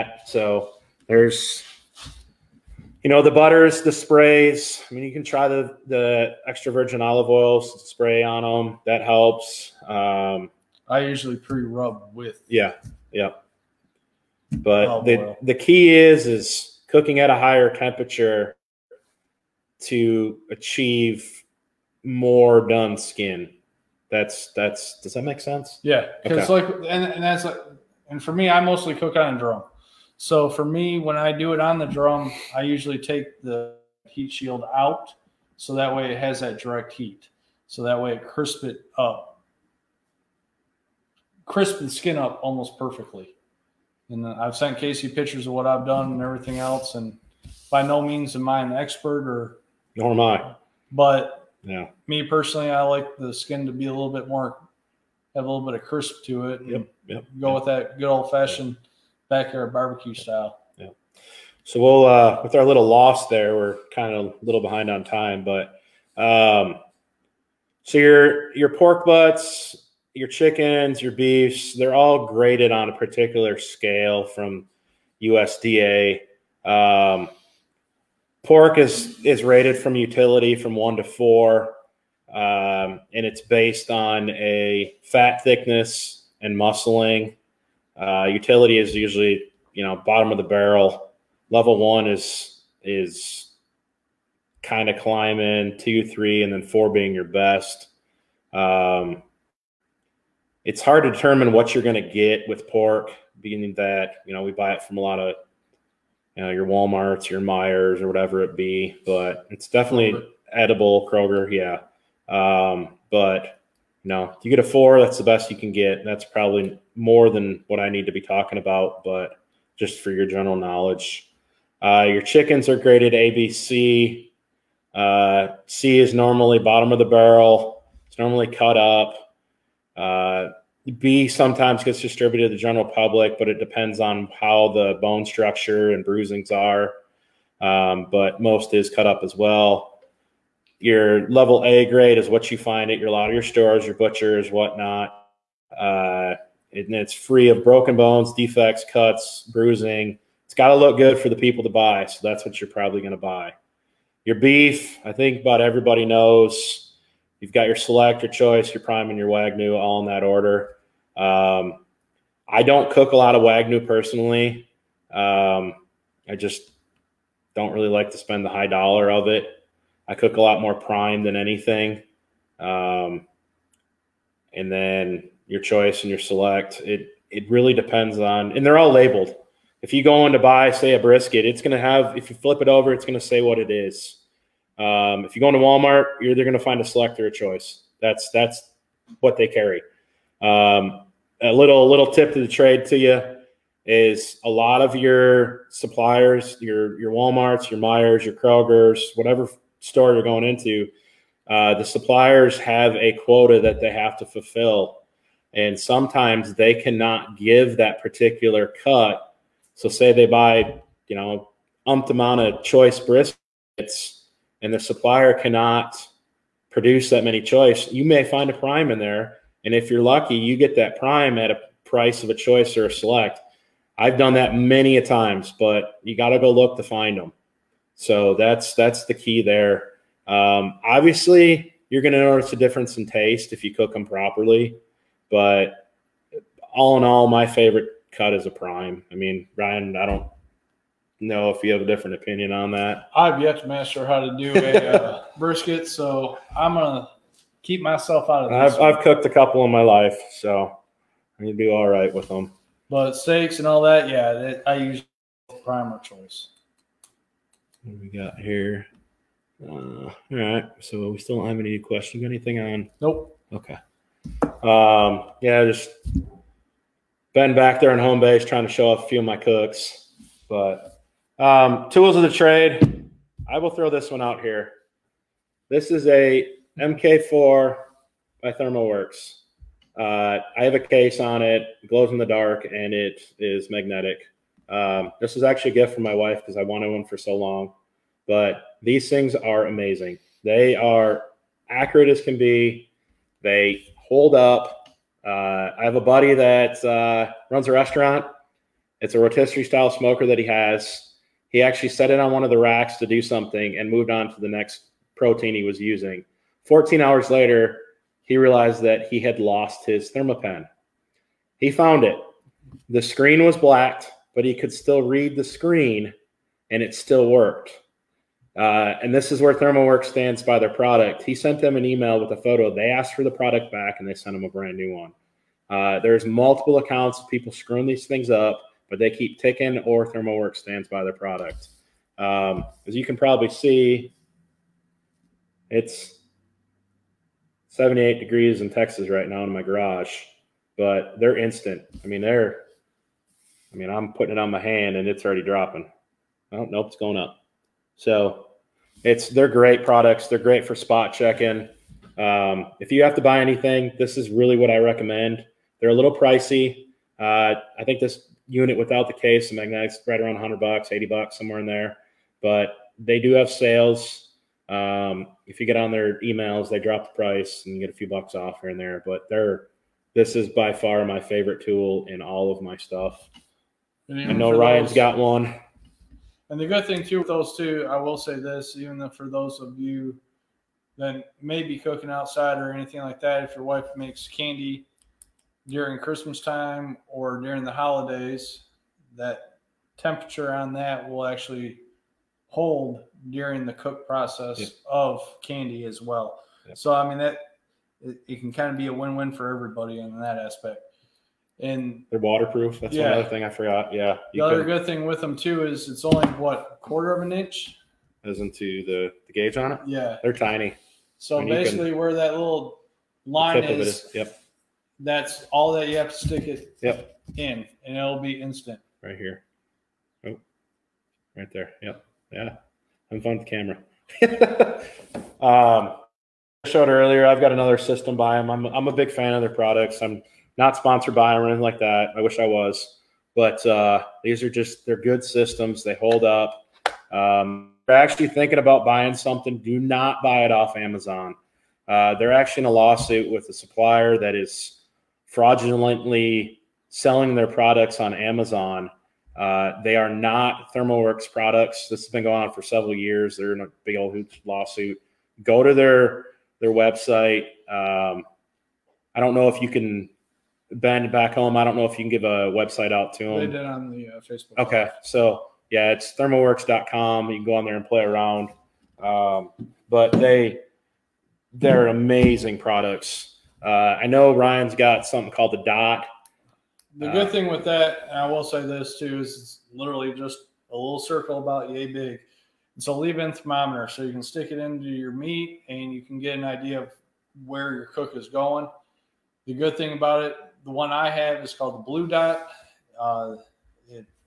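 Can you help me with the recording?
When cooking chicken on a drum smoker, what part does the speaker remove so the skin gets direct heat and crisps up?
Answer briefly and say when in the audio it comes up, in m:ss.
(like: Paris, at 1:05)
heat shield, at 0:34.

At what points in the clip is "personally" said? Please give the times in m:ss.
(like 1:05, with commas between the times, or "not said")
0:52, 2:43.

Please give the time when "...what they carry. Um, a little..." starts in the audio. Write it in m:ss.
3:09.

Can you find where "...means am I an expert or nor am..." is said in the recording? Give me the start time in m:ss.
0:48.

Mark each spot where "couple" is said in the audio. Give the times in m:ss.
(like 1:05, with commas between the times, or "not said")
4:09.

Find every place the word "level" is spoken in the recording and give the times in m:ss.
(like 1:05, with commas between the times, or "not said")
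1:31, 2:21.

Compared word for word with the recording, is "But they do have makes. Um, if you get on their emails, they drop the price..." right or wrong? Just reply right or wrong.
wrong.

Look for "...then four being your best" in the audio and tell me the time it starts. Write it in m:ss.
1:36.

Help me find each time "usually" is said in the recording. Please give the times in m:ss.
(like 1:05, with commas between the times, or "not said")
0:11, 0:32, 1:28.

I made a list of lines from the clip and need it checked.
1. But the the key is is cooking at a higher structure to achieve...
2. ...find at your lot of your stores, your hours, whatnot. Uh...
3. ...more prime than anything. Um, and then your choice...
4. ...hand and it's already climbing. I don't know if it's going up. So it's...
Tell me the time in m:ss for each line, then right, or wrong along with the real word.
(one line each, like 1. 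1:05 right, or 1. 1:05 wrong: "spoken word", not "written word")
1. 0:14 wrong: "temperature", not "structure"
2. 2:22 wrong: "butchers", not "hours"
3. 2:50 right
4. 5:44 wrong: "dropping", not "climbing".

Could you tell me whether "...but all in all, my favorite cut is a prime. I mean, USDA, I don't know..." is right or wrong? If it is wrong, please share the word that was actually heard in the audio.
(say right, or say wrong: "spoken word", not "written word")
wrong: "Ryan", not "USDA".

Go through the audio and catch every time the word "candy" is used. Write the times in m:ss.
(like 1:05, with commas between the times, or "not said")
6:24, 6:35.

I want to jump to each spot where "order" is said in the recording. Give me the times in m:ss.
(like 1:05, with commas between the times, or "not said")
2:40.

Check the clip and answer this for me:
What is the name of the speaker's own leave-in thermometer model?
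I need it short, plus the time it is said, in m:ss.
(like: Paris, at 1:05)
Blue Dot, at 8:11.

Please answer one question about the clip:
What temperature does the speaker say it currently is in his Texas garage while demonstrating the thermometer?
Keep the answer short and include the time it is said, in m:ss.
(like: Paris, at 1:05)
78 degrees, at 5:37.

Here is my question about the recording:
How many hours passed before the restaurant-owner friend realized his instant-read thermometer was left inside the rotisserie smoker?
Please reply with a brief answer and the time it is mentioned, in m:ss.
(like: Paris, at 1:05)
14, at 5:06.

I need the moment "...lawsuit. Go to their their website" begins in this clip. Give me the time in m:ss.
7:34.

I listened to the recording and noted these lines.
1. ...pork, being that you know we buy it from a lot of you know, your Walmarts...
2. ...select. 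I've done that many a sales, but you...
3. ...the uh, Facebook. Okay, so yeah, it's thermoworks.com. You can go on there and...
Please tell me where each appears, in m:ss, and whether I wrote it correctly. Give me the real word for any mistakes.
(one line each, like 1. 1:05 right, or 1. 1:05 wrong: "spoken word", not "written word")
1. 1:42 right
2. 3:42 wrong: "times", not "sales"
3. 7:43 right.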